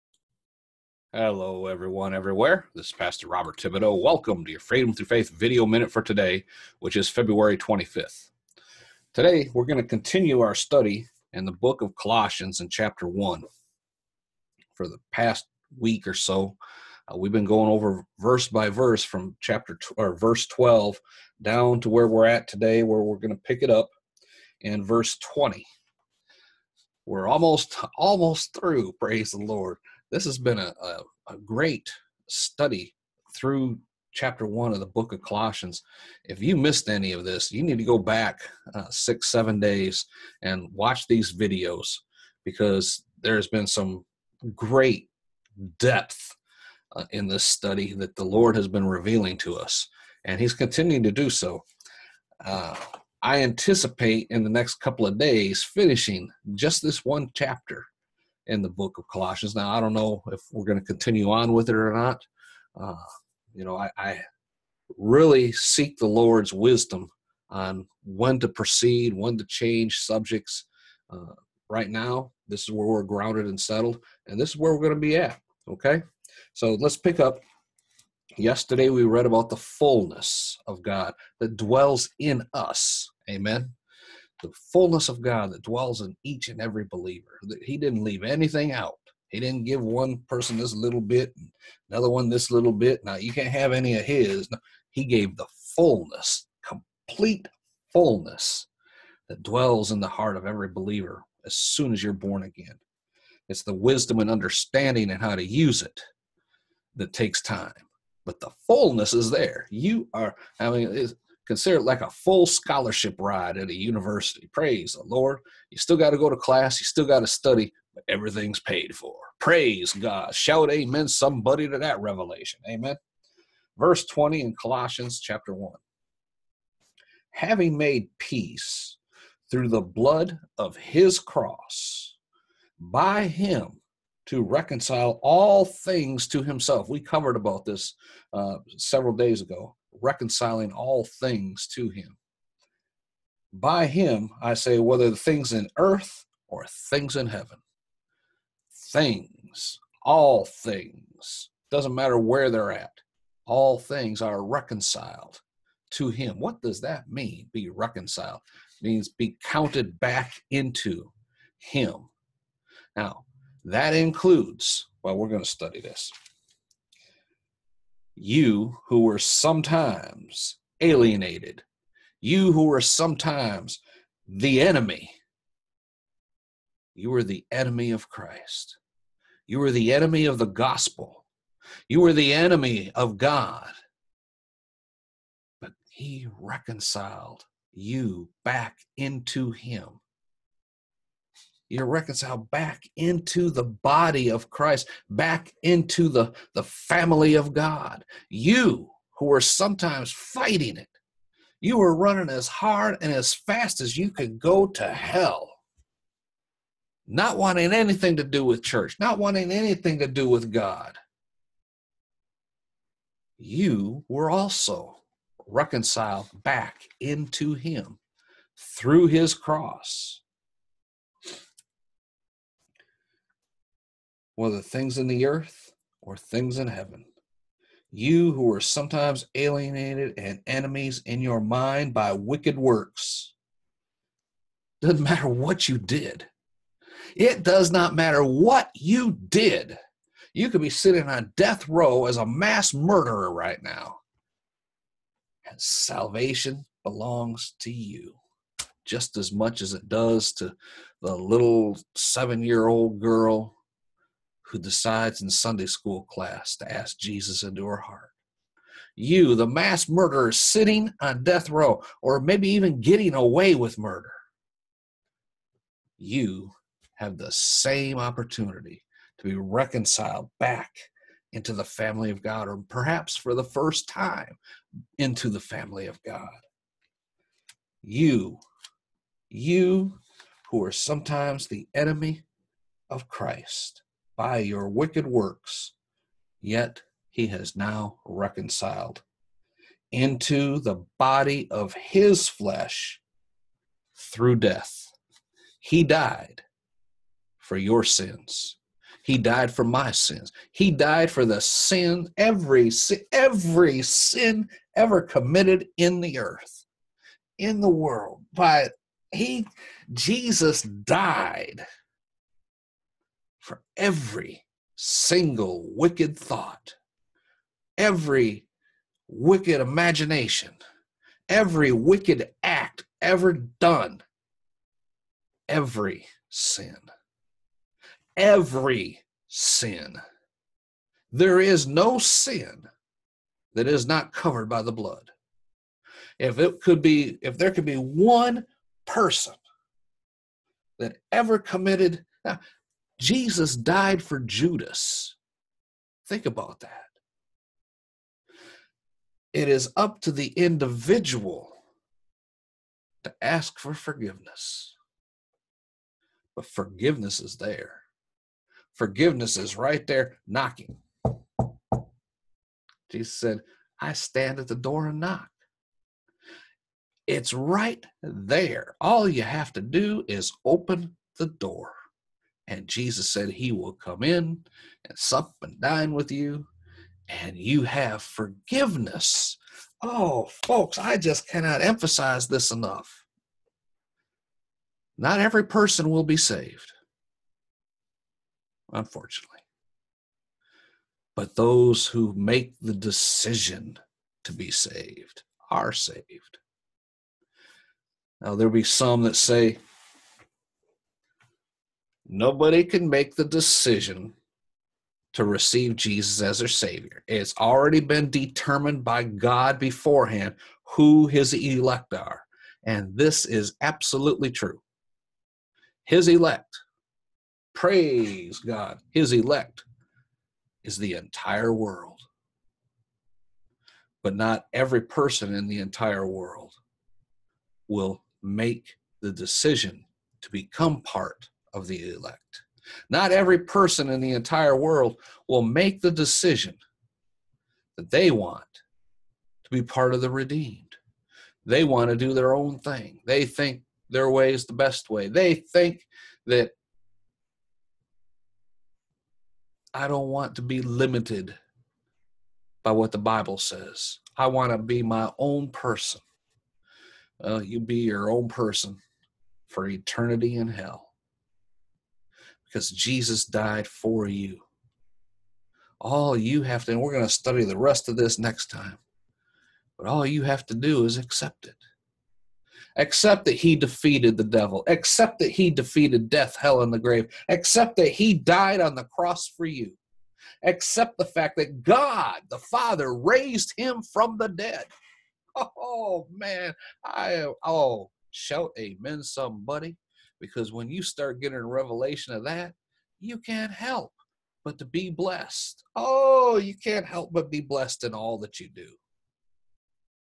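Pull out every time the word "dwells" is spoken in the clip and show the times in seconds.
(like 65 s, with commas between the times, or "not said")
81 s, 85 s, 99 s.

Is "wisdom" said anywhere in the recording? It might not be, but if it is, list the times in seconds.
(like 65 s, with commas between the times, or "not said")
66 s, 103 s.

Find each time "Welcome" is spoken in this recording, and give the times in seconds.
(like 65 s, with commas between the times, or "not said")
4 s.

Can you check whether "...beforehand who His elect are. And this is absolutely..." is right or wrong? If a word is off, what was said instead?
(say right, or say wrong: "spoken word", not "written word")
right.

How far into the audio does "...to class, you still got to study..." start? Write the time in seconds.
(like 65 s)
116 s.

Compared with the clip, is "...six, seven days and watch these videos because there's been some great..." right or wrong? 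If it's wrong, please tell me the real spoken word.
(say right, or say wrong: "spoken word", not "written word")
right.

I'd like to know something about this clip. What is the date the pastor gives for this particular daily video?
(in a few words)
February 25th.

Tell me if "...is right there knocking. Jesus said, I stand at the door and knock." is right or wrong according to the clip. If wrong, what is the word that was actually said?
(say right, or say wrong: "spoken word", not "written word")
right.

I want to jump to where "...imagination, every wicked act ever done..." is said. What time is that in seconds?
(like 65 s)
319 s.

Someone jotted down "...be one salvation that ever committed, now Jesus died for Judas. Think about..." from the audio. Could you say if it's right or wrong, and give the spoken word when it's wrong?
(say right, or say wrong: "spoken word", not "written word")
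wrong: "person", not "salvation".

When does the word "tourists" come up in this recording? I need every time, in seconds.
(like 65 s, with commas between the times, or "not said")
not said.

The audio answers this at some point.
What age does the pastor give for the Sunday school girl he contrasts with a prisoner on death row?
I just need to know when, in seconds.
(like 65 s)
251 s.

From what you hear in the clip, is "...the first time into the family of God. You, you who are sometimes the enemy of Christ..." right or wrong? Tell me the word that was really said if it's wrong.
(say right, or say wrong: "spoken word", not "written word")
right.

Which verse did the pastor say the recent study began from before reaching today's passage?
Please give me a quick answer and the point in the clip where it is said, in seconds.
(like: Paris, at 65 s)
12, at 20 s.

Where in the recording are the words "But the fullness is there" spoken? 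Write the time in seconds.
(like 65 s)
108 s.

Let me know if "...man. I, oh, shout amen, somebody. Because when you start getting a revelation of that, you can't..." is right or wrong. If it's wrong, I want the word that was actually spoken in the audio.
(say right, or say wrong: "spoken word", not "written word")
right.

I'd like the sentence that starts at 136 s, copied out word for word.
We covered about this uh, several days ago reconciling all things to him.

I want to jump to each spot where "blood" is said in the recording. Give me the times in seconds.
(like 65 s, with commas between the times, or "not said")
129 s, 334 s.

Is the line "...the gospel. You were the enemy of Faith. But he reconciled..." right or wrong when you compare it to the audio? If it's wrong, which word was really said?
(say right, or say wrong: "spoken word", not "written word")
wrong: "God", not "Faith".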